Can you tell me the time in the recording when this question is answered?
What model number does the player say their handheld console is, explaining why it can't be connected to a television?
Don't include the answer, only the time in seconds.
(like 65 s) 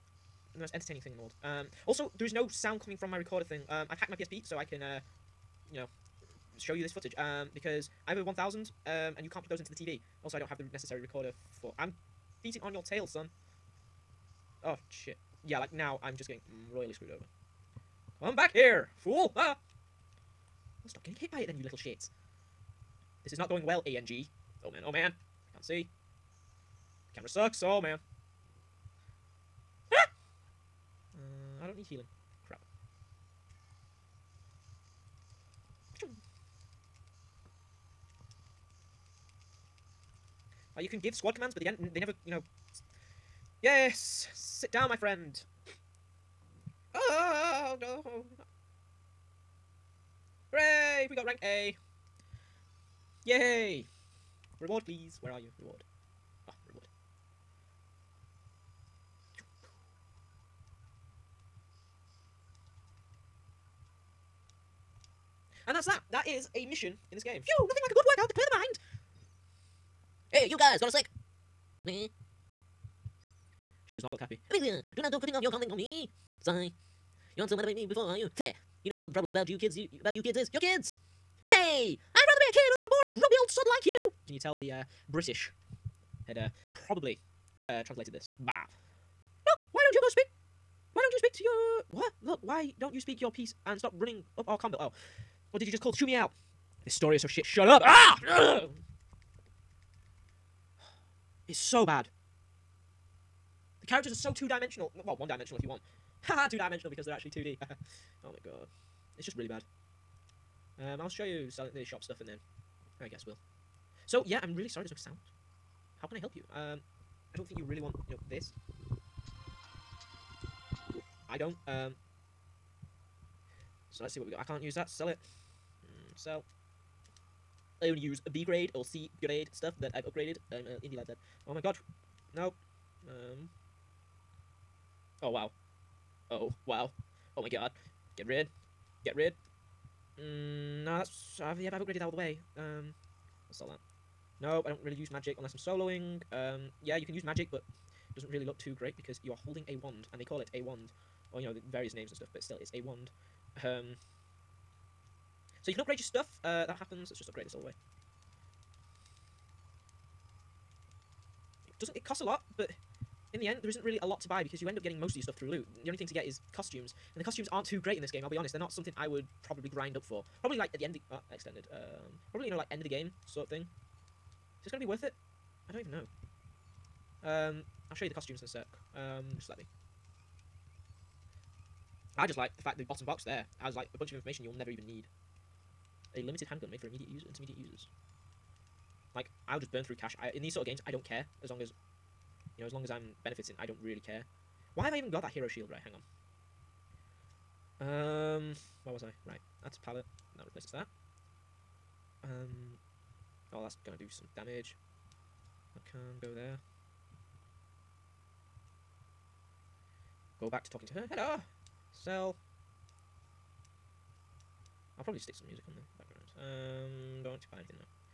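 8 s.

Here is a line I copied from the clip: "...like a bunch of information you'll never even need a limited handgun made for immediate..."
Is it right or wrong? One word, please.
right.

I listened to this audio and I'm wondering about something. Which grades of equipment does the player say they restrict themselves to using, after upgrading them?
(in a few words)
B grade or C grade.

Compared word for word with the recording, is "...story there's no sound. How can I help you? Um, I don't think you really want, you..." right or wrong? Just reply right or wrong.
wrong.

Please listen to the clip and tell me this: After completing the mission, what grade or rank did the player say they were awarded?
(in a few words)
rank A.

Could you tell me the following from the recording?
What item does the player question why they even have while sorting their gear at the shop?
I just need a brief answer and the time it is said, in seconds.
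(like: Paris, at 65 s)
hero shield, at 195 s.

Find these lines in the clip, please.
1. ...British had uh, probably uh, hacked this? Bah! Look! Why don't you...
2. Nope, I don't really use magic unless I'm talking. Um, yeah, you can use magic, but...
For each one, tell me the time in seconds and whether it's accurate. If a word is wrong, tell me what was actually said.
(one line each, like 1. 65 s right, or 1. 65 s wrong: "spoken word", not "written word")
1. 85 s wrong: "translated", not "hacked"
2. 144 s wrong: "soloing", not "talking".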